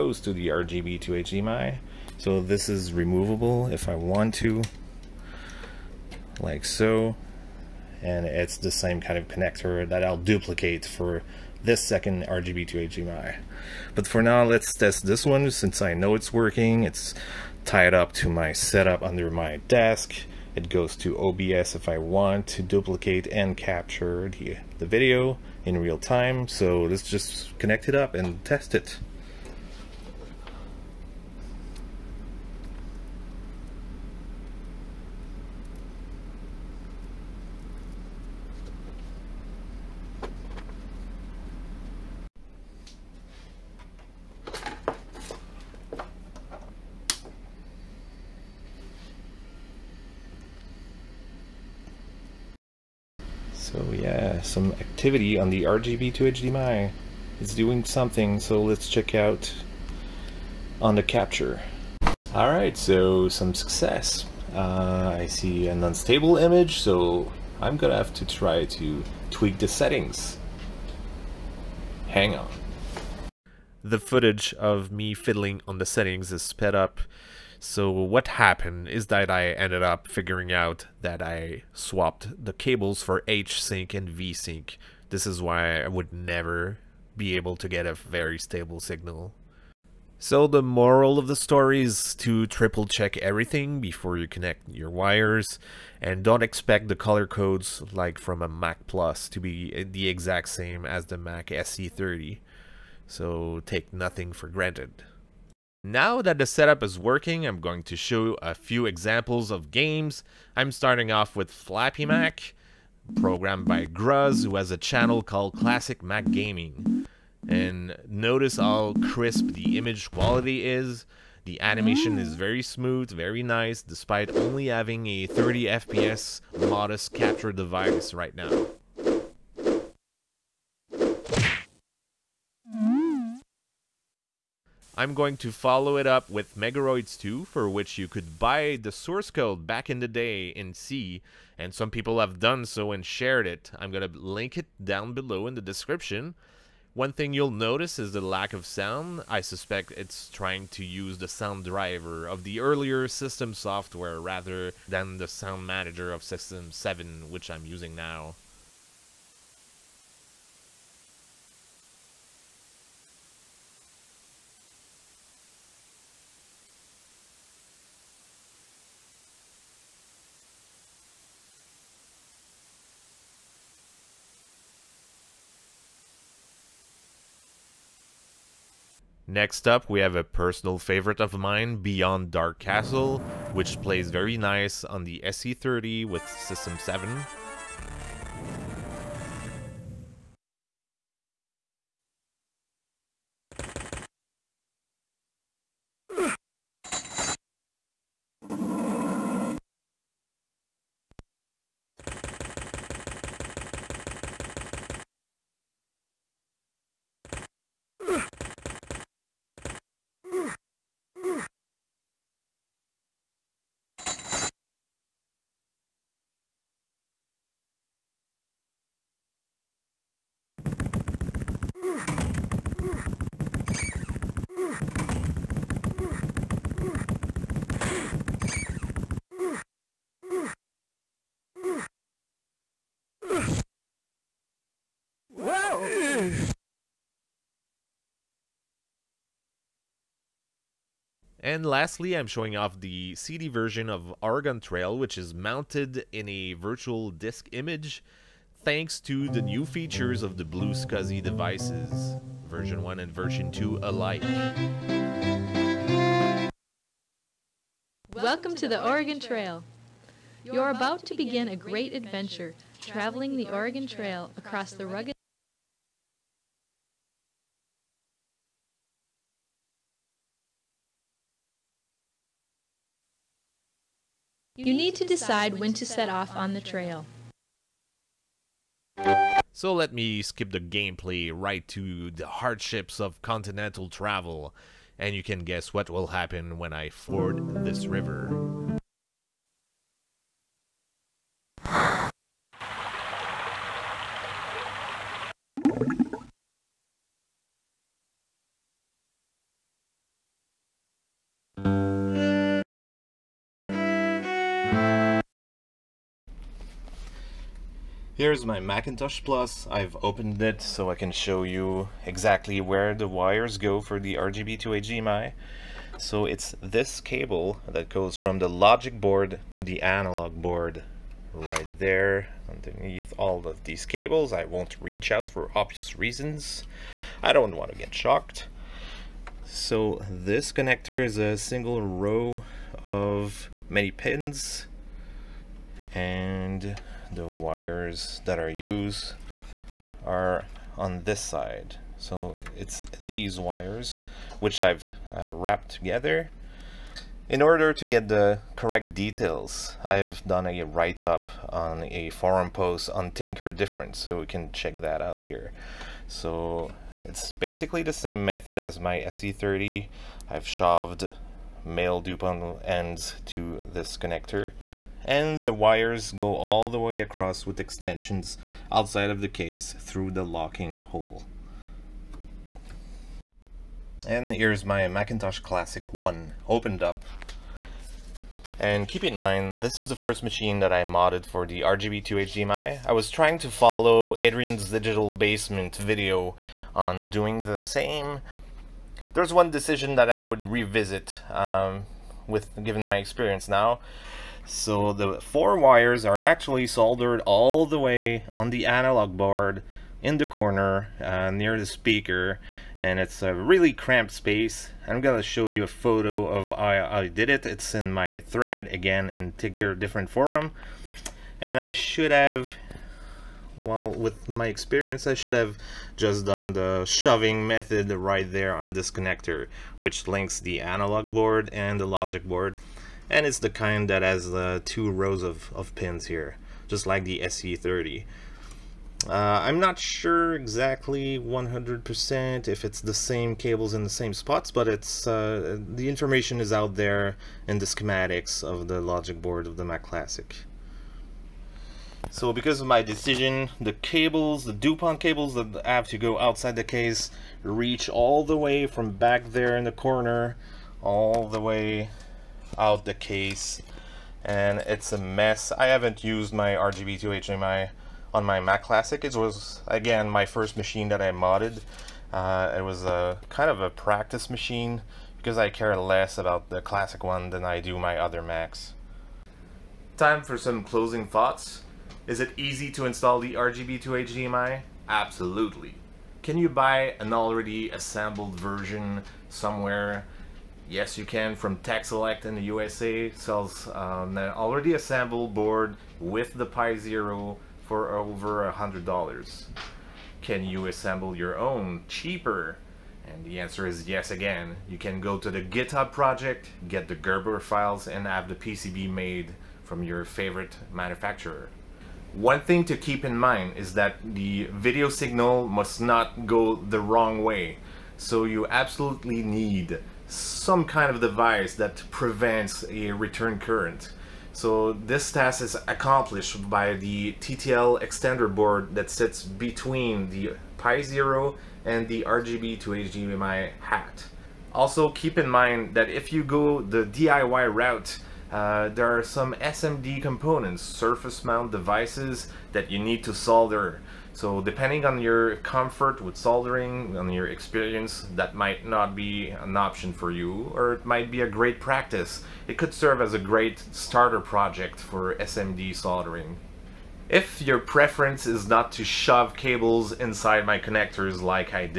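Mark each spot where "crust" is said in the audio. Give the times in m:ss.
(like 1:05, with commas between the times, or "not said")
not said.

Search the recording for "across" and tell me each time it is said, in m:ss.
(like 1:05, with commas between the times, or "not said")
4:24, 6:07.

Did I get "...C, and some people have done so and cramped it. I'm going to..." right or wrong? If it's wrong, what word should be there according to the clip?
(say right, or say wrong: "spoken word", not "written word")
wrong: "shared", not "cramped".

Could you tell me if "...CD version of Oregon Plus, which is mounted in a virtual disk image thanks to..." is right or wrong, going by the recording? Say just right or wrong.
wrong.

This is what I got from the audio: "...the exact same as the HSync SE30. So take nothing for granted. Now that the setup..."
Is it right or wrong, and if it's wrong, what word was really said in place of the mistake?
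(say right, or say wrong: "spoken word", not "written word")
wrong: "Mac", not "HSync".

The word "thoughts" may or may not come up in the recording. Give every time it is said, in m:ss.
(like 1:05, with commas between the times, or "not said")
7:51.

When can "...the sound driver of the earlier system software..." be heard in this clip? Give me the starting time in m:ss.
2:31.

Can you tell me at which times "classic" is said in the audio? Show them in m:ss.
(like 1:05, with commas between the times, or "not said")
1:55, 6:15, 7:19, 7:38, 7:46.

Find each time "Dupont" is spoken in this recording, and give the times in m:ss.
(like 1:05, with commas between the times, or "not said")
6:02, 7:24.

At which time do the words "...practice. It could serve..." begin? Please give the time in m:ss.
9:01.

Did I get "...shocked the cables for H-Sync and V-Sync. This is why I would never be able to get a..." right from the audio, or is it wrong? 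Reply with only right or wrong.
wrong.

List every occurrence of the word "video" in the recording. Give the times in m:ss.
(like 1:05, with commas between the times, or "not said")
0:24, 6:25, 8:24.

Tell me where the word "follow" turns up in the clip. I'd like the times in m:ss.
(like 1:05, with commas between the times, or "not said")
2:15, 6:23.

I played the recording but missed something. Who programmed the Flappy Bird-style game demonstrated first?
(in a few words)
Gruz.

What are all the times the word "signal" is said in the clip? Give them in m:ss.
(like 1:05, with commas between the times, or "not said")
1:28, 8:24.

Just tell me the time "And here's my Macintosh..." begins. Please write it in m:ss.
6:14.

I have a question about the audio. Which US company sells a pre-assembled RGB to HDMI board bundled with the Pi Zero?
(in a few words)
Texelec.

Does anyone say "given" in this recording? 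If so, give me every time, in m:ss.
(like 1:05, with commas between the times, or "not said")
6:32.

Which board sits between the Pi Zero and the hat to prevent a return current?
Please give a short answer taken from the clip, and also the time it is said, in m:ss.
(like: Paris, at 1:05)
TTL extender board, at 8:37.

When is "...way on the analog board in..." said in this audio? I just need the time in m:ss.
6:37.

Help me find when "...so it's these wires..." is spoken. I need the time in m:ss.
5:41.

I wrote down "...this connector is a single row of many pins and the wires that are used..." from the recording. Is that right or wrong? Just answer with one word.
right.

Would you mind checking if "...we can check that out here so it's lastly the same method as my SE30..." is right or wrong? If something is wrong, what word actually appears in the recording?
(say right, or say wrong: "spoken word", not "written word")
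wrong: "basically", not "lastly".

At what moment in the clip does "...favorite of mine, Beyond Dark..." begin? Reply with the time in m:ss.
3:00.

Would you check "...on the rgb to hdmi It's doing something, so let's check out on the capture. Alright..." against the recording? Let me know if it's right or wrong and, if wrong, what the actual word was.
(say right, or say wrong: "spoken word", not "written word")
right.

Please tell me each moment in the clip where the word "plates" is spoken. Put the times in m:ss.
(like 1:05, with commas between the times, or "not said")
not said.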